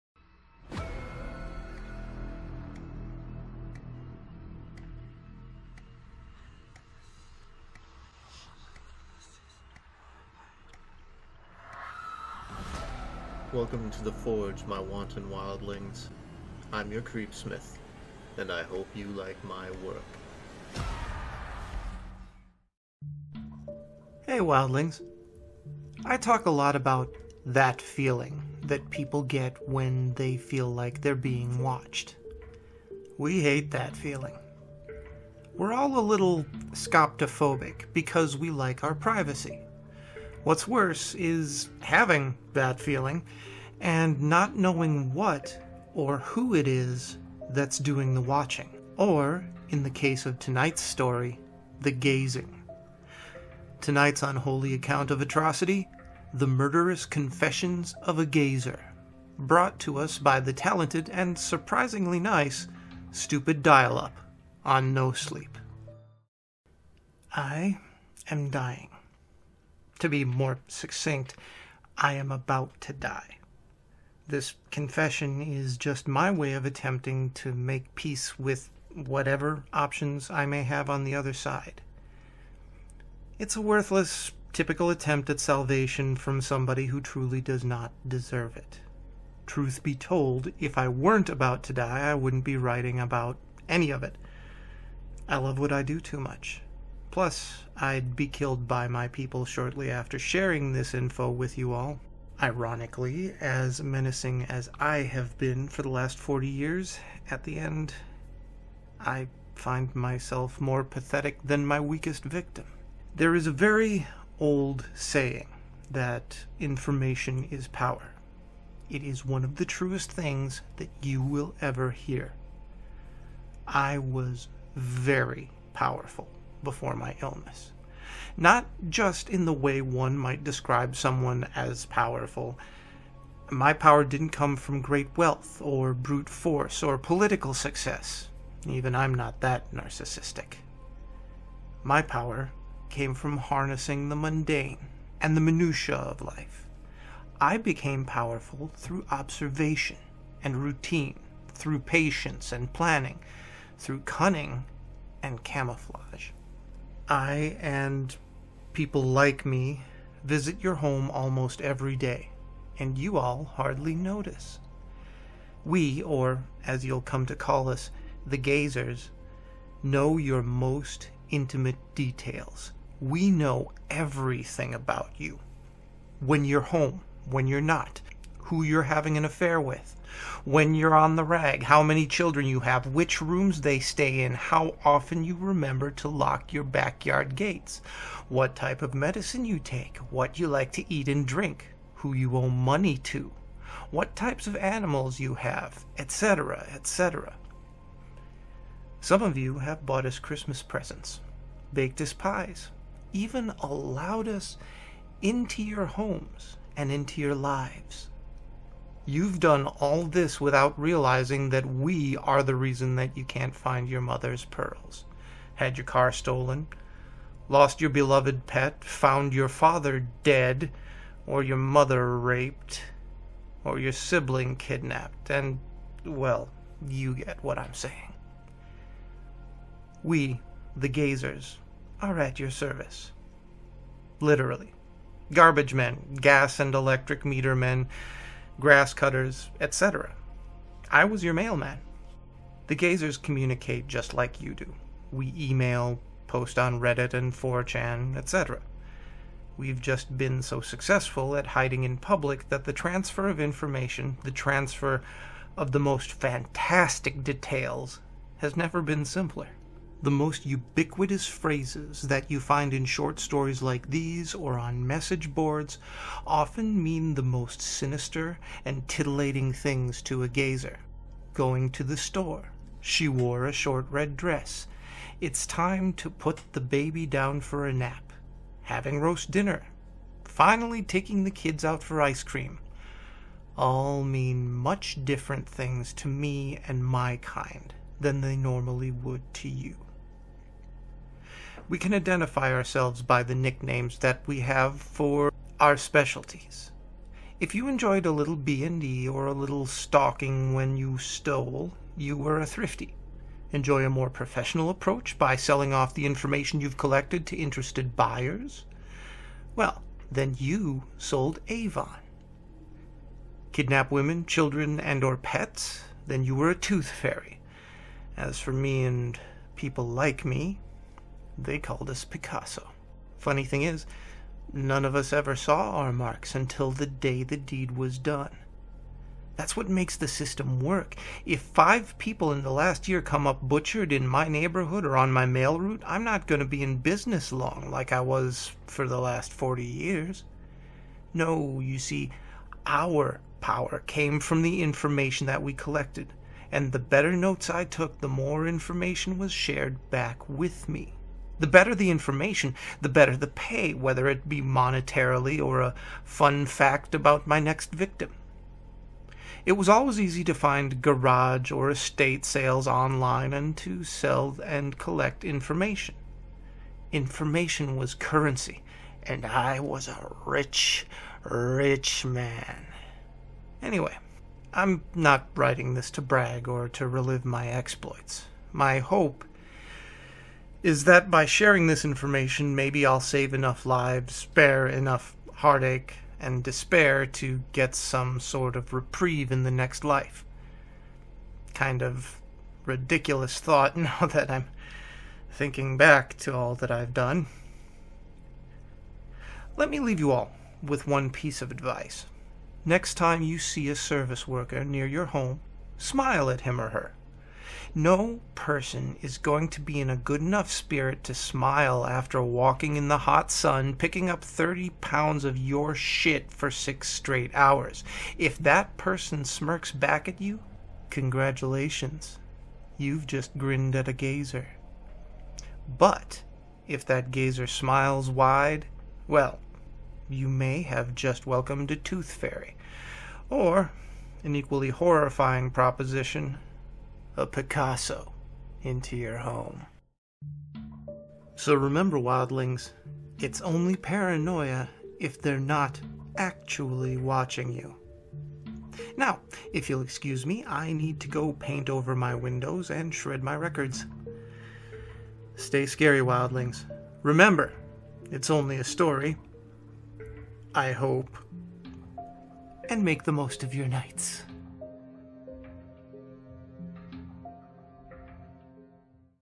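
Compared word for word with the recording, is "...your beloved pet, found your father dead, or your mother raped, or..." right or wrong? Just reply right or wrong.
right.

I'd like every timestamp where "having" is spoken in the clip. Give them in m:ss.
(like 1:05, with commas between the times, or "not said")
0:41, 2:58, 4:38.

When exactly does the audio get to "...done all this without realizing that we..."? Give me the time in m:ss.
3:29.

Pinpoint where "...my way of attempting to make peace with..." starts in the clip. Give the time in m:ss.
1:16.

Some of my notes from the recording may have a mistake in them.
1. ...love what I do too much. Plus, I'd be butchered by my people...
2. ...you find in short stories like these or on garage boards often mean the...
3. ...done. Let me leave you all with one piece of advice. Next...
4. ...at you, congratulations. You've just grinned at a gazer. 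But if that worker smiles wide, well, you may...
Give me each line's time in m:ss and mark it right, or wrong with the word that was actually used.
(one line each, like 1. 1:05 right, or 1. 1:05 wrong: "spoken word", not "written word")
1. 1:35 wrong: "killed", not "butchered"
2. 4:22 wrong: "message", not "garage"
3. 6:36 right
4. 7:00 wrong: "gazer", not "worker".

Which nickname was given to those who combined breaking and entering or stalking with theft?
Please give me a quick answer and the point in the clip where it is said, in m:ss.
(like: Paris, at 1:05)
Thrifty, at 5:02.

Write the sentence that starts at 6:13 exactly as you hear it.
Anyway, I'm not writing this to brag or to relive my exploits.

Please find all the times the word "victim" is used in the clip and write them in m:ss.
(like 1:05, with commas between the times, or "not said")
1:52, 5:57.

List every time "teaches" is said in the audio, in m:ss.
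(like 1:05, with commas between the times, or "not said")
not said.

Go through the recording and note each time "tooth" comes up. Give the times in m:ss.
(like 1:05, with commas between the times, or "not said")
5:16, 7:11.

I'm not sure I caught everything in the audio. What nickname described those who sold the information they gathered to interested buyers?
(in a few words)
Sold Avon.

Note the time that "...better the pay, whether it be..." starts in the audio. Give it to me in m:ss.
5:52.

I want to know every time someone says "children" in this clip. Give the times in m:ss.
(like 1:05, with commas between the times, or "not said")
3:02, 5:14.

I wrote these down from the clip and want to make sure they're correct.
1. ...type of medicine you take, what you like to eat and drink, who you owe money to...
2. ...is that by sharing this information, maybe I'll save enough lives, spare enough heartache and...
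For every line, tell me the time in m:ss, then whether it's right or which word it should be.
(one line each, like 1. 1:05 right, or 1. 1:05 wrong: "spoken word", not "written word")
1. 3:08 right
2. 6:20 right.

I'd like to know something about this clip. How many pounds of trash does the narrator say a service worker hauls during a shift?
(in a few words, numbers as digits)
30.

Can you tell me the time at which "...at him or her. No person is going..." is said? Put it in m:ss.
6:46.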